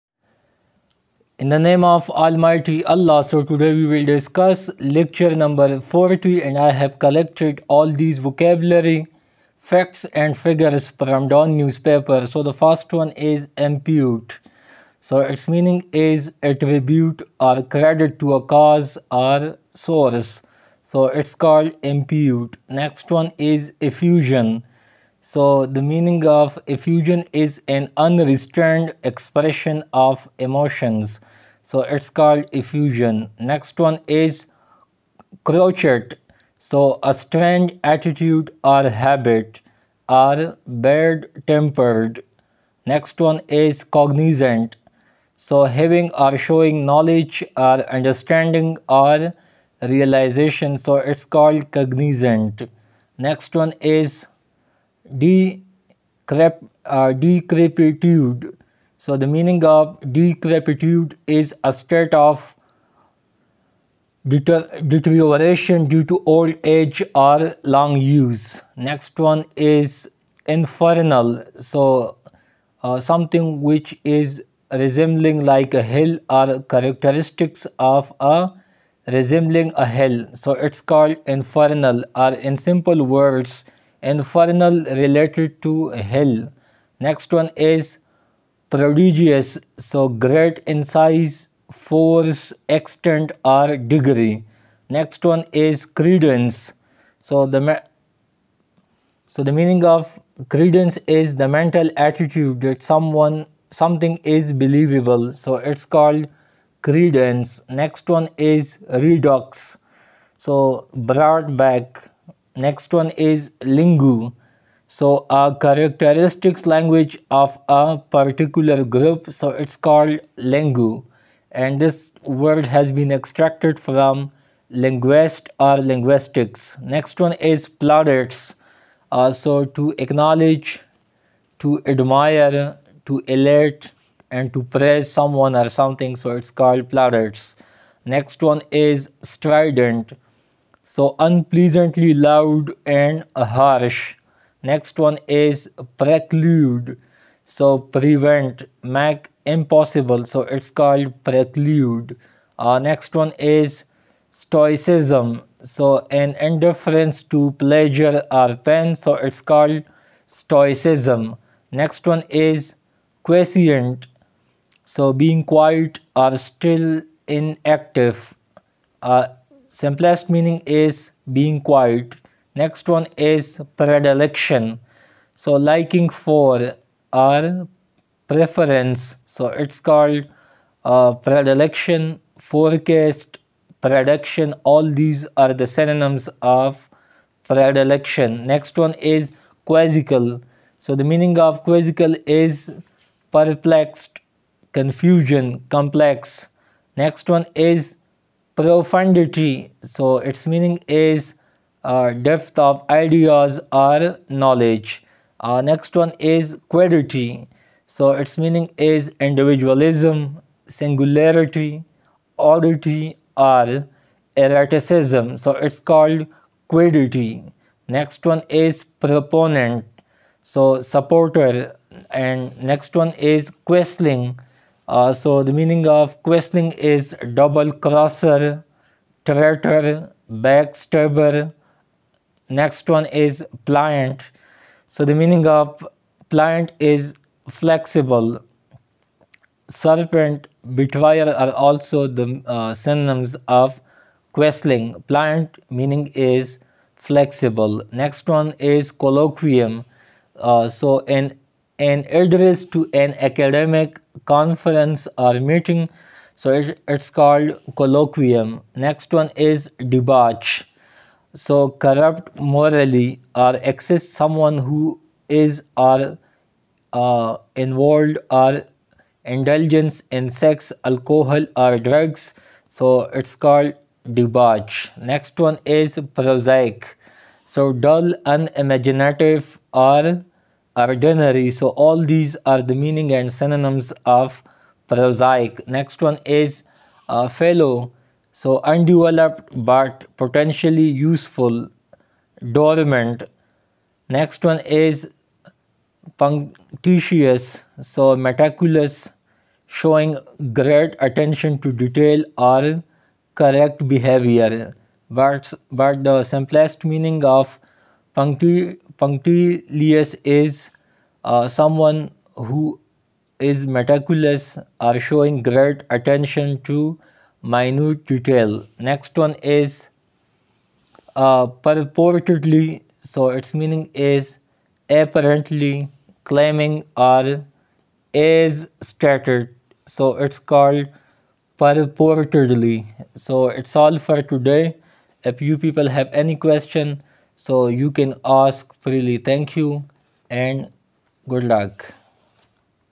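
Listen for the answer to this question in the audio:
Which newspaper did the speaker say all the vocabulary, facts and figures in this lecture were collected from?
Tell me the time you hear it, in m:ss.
0:11.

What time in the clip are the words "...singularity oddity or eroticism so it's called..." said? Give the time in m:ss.
3:30.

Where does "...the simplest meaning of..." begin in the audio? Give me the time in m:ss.
5:06.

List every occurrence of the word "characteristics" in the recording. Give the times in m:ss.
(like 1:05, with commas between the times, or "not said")
1:16, 1:55.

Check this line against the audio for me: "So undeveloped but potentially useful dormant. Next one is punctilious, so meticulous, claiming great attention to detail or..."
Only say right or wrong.
wrong.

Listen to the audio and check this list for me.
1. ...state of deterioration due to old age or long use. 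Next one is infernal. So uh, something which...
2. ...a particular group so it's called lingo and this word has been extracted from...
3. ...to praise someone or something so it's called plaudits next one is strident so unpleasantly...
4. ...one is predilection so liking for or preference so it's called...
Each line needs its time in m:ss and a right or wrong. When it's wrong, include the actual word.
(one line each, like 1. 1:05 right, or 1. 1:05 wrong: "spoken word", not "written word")
1. 1:01 right
2. 1:57 right
3. 2:14 right
4. 2:52 right.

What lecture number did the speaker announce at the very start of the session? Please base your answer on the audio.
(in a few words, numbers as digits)
40.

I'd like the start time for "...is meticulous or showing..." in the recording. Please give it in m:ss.
5:13.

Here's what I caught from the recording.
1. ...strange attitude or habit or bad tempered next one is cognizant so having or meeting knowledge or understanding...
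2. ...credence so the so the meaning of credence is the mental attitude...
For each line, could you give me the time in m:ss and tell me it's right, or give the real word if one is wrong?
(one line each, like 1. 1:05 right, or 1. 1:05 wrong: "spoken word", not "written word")
1. 0:37 wrong: "showing", not "meeting"
2. 1:36 right.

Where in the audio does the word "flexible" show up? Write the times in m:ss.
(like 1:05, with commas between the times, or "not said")
3:57, 4:06.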